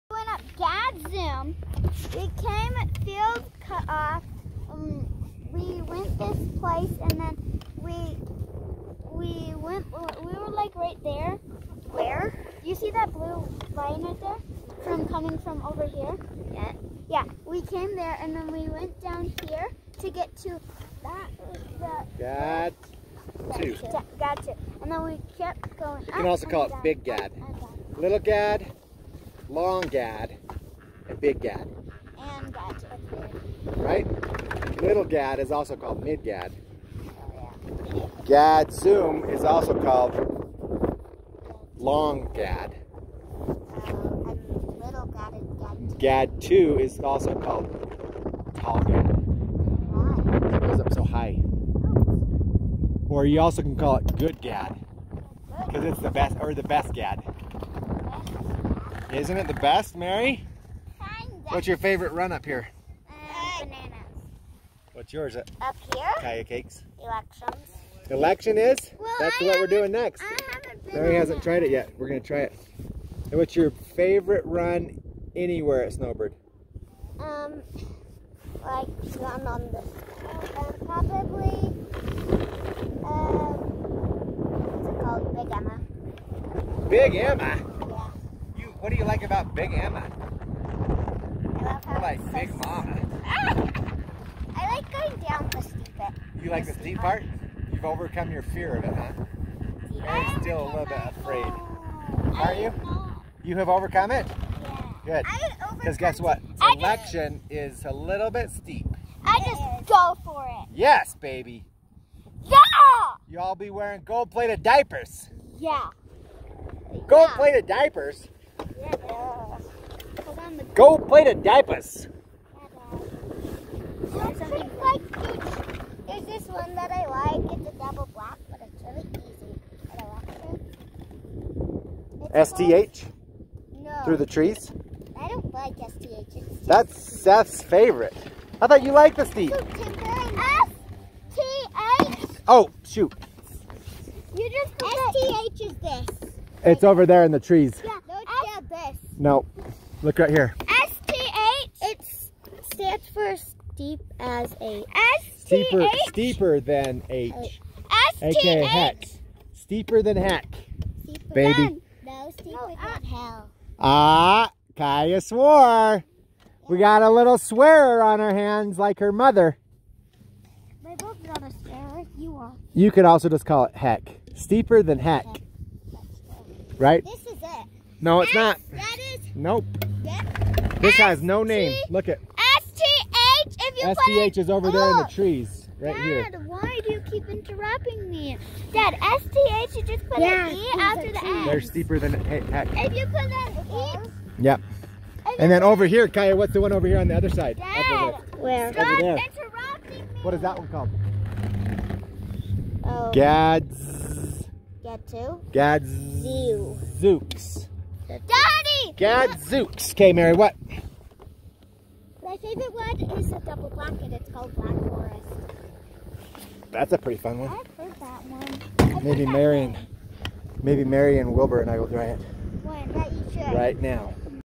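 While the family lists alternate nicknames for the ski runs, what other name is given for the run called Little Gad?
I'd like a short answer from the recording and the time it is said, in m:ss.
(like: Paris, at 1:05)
Mid Gad, at 0:36.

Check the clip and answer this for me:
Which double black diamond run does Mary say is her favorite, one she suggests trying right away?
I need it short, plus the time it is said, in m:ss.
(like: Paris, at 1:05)
Black Forest, at 3:34.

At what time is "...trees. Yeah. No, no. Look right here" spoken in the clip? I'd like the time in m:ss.
2:27.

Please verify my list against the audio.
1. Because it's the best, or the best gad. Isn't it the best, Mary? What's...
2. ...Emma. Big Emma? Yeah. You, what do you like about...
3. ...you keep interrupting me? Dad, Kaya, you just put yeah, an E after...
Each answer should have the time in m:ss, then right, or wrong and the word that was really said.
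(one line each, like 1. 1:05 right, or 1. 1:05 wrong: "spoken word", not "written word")
1. 0:55 right
2. 1:27 right
3. 3:06 wrong: "SDH", not "Kaya".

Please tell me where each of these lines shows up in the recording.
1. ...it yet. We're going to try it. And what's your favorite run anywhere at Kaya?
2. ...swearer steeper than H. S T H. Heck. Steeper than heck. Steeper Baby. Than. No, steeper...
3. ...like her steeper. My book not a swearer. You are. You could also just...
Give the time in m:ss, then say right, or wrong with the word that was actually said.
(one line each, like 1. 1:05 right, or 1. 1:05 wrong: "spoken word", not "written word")
1. 1:11 wrong: "Snowbird", not "Kaya"
2. 2:35 wrong: "steeper", not "swearer"
3. 2:48 wrong: "mother", not "steeper".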